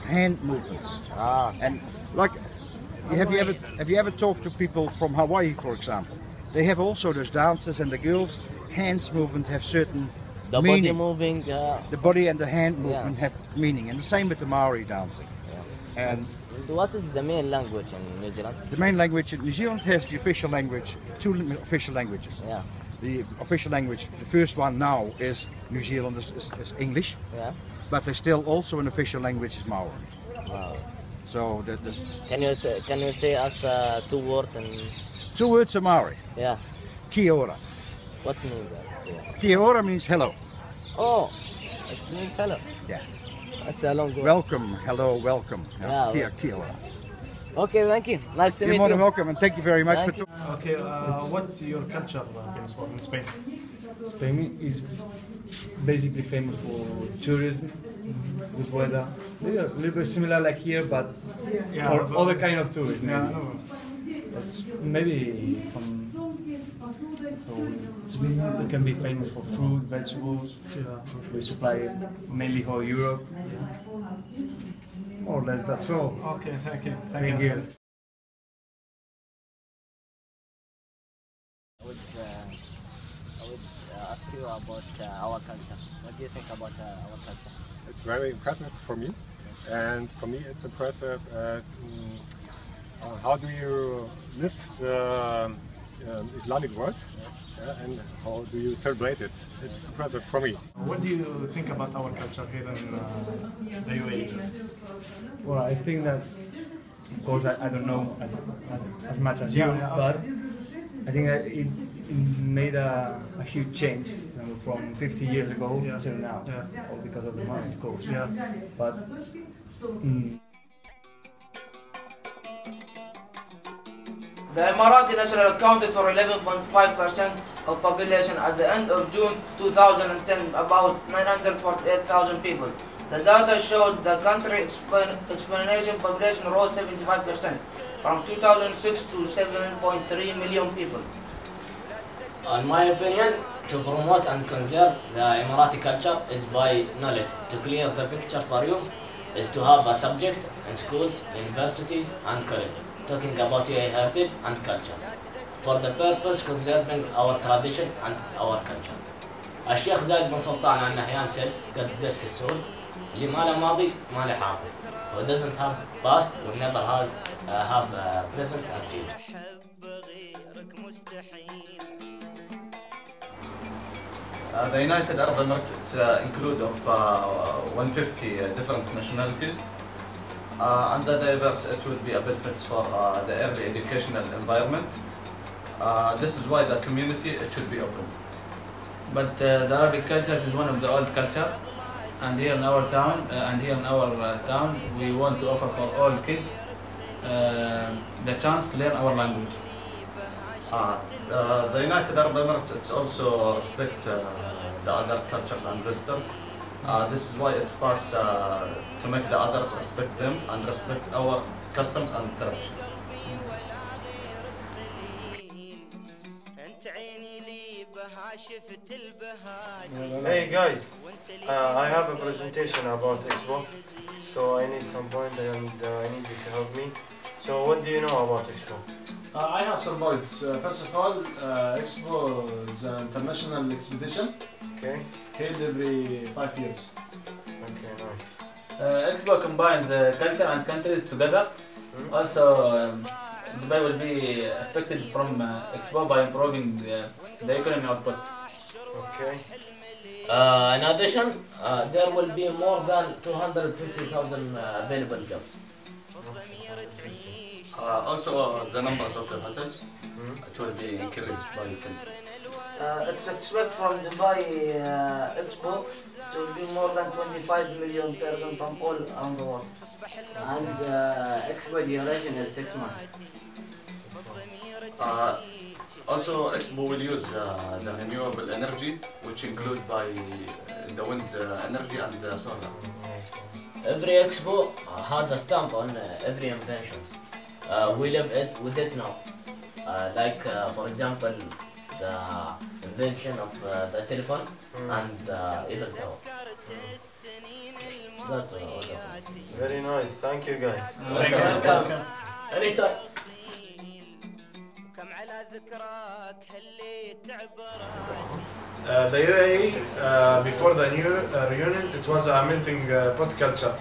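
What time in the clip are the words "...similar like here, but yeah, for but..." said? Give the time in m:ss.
1:00.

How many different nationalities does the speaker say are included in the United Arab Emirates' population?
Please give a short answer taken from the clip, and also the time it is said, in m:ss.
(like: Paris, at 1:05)
150, at 2:57.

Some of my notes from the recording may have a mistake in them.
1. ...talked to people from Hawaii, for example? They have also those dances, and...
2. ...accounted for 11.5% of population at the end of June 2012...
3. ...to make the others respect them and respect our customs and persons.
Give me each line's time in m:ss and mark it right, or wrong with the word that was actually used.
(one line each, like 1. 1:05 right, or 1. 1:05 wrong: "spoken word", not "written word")
1. 0:04 right
2. 2:05 wrong: "2010", not "2012"
3. 3:29 wrong: "traditions", not "persons".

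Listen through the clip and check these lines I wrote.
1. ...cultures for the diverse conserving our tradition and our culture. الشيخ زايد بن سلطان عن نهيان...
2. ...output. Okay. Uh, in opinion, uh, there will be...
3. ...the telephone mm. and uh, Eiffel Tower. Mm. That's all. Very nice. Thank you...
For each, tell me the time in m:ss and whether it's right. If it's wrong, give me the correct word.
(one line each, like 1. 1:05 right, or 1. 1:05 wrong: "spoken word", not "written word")
1. 2:34 wrong: "purpose", not "diverse"
2. 4:07 wrong: "addition", not "opinion"
3. 4:53 right.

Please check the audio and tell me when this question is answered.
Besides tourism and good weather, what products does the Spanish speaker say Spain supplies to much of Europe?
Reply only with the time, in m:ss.
1:09.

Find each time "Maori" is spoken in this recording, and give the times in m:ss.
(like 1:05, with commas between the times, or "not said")
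0:14, 0:29, 0:35.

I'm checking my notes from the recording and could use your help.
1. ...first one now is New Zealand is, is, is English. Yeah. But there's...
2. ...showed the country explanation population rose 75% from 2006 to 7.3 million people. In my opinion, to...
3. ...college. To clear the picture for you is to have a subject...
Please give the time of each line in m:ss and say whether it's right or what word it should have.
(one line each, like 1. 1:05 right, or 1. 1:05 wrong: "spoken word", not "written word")
1. 0:24 right
2. 2:13 right
3. 2:26 wrong: "knowledge", not "college".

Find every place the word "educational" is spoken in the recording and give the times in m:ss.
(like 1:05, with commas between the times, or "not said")
3:03.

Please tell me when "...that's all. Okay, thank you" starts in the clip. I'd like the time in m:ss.
1:15.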